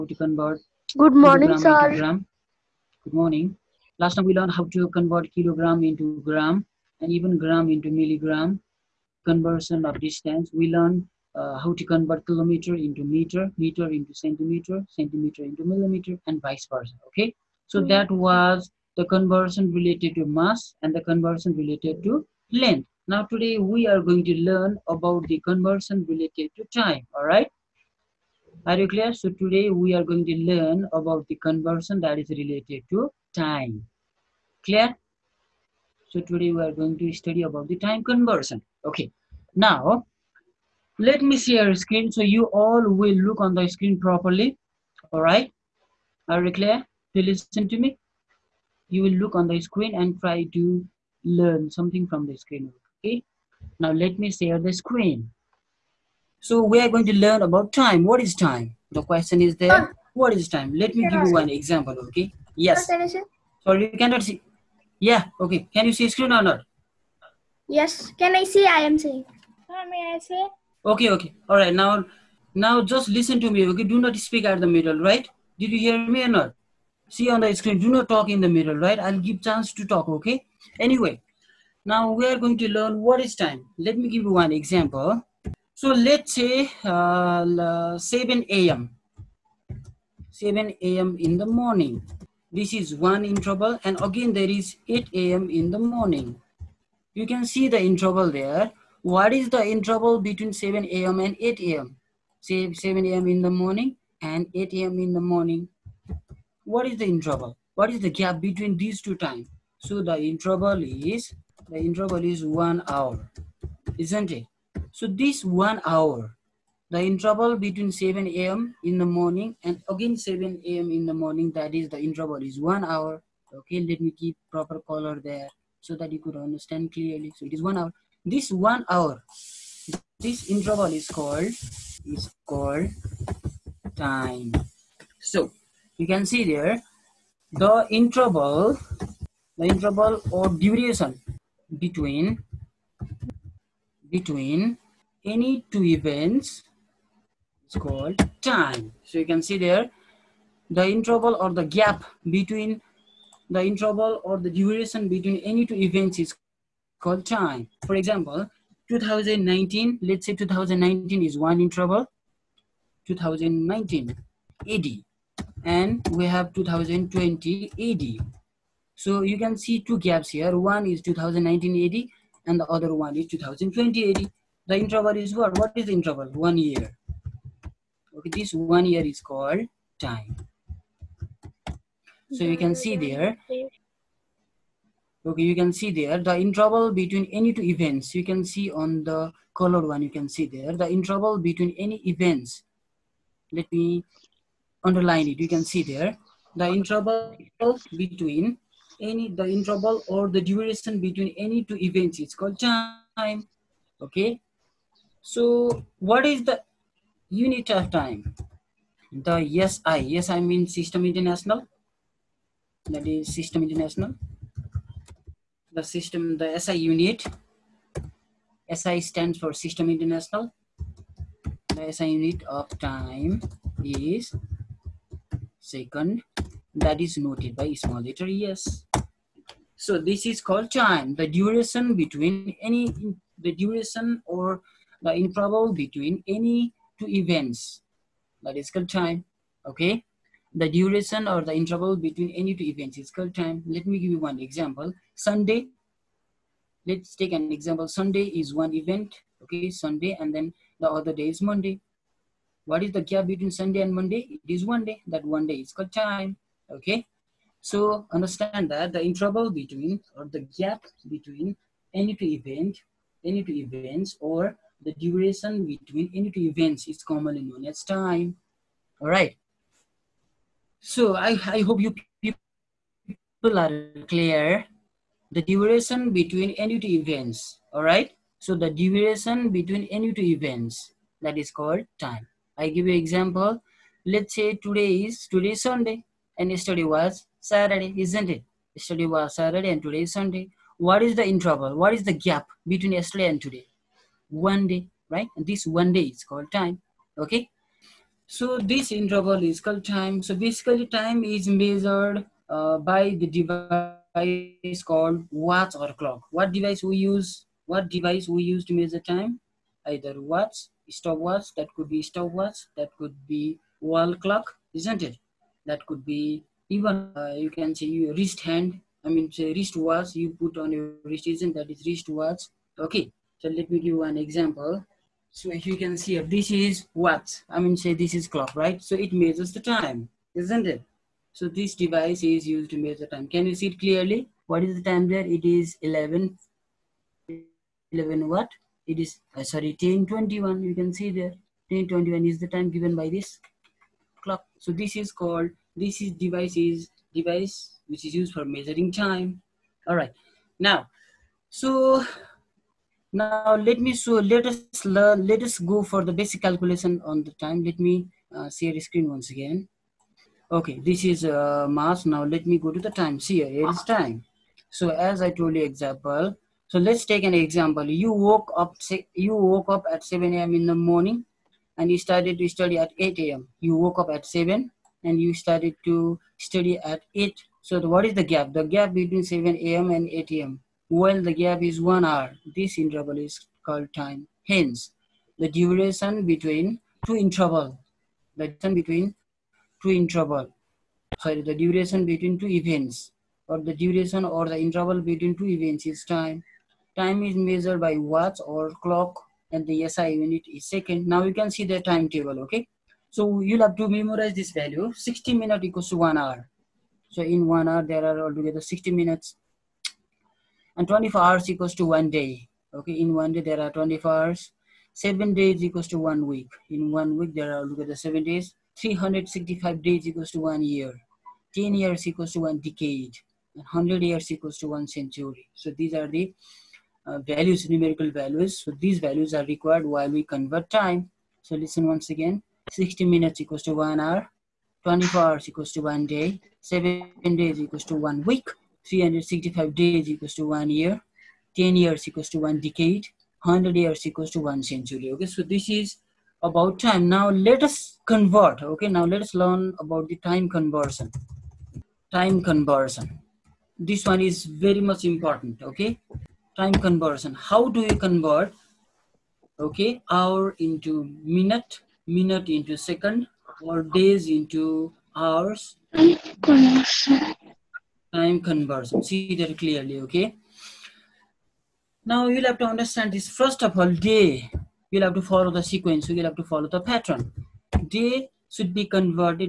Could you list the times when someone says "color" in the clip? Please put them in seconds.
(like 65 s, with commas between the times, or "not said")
124 s, 189 s.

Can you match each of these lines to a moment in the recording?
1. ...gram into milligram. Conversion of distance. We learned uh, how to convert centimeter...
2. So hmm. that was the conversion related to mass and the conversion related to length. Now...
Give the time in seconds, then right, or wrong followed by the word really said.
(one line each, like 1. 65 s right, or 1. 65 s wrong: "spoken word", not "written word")
1. 7 s wrong: "kilometer", not "centimeter"
2. 17 s right.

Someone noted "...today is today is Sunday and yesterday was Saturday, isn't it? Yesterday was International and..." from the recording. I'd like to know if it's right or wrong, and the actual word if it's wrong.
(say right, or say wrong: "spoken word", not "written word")
wrong: "Saturday", not "International".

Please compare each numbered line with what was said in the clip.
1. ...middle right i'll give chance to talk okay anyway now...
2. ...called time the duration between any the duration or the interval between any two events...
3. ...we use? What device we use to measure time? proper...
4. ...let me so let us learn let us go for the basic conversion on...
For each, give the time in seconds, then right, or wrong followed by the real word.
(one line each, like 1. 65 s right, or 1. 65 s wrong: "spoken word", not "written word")
1. 78 s right
2. 230 s right
3. 306 s wrong: "either", not "proper"
4. 353 s wrong: "calculation", not "conversion".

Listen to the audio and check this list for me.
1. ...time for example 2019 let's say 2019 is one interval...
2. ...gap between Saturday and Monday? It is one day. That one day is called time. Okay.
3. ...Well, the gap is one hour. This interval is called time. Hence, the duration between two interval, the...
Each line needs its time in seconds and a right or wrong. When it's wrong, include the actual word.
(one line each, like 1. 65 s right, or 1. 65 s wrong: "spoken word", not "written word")
1. 157 s right
2. 253 s wrong: "Sunday", not "Saturday"
3. 380 s right.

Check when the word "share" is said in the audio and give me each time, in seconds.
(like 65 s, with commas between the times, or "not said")
41 s, 54 s, 358 s.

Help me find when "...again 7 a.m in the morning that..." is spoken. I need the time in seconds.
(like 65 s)
119 s.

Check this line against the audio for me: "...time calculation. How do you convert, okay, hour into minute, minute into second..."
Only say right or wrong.
wrong.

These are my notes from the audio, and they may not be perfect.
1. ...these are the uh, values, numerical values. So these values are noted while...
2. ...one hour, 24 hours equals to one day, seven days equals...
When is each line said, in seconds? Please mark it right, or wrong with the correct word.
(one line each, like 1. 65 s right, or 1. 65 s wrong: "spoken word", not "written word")
1. 425 s wrong: "required", not "noted"
2. 433 s right.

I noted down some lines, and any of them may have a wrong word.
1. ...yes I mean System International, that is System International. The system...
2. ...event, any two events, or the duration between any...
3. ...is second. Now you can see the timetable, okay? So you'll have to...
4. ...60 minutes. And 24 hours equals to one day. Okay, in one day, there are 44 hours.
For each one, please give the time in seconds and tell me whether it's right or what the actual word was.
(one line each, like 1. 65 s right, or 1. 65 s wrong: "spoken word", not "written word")
1. 210 s right
2. 262 s right
3. 400 s right
4. 408 s wrong: "24", not "44".